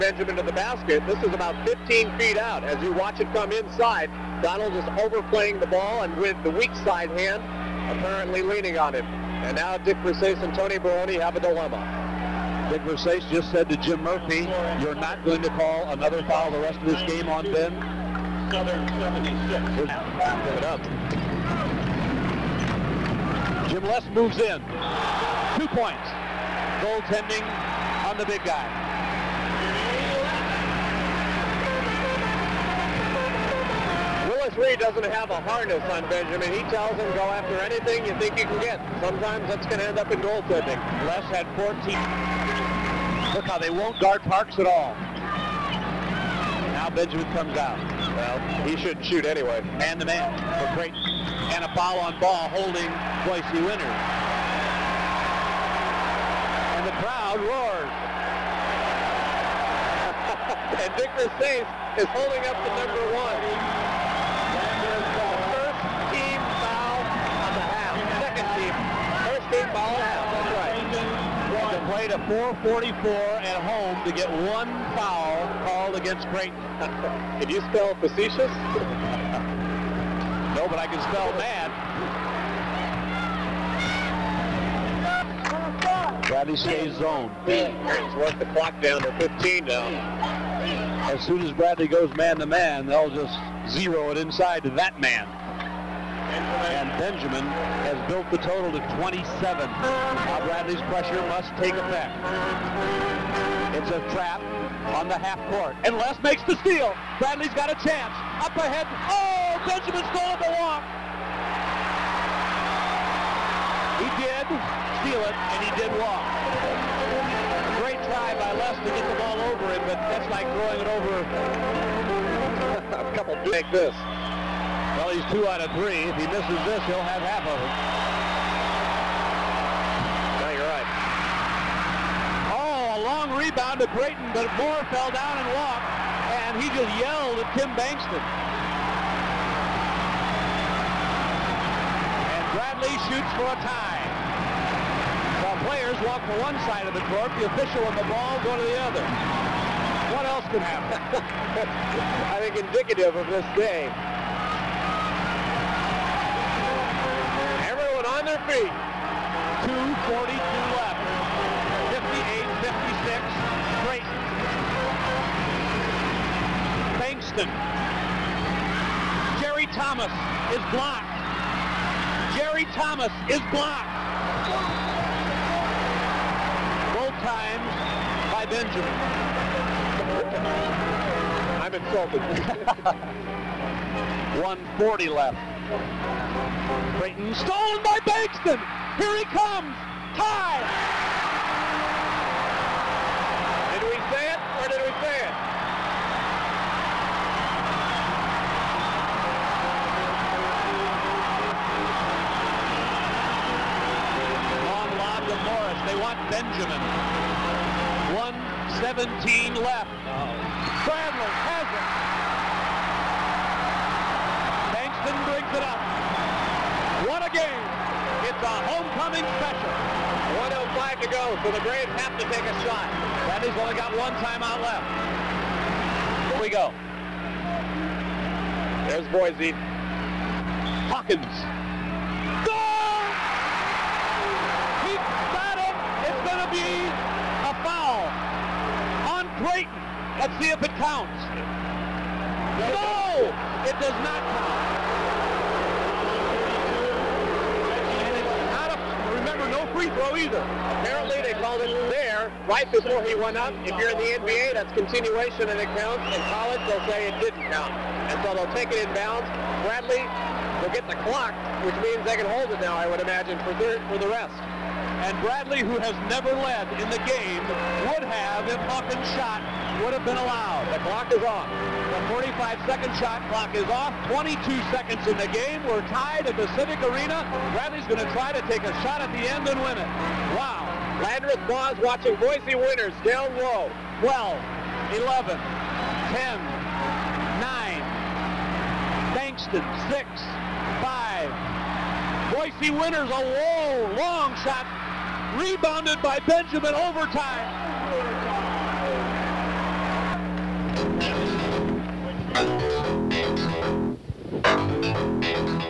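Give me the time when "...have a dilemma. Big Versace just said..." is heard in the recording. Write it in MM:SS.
00:11.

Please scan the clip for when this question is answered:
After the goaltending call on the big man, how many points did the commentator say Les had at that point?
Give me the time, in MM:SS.
00:41.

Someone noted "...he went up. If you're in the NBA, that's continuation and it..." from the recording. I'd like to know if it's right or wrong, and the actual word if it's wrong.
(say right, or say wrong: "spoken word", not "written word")
right.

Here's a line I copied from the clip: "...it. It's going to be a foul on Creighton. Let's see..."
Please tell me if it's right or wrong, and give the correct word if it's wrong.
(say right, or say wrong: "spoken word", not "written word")
right.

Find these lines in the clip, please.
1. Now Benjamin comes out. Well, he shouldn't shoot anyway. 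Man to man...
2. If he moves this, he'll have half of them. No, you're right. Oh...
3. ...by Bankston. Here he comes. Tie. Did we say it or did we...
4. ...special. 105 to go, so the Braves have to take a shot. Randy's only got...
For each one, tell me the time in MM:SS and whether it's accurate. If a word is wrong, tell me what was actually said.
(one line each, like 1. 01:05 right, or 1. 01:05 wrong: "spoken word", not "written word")
1. 00:46 right
2. 02:06 wrong: "misses", not "moves"
3. 03:07 right
4. 03:39 right.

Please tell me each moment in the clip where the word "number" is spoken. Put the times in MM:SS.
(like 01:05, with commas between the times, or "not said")
01:02.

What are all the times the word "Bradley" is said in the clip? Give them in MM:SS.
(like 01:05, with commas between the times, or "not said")
01:26, 01:31, 01:40, 01:47, 02:22, 04:19, 04:25, 04:37.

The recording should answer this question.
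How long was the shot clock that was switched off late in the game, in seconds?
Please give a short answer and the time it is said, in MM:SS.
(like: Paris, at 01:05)
45, at 04:32.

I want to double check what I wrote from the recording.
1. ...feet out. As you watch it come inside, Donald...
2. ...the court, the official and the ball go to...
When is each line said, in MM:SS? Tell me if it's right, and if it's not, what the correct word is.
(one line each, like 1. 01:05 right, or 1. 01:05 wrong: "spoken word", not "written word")
1. 00:02 right
2. 02:26 right.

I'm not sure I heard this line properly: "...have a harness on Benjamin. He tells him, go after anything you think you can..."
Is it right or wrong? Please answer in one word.
right.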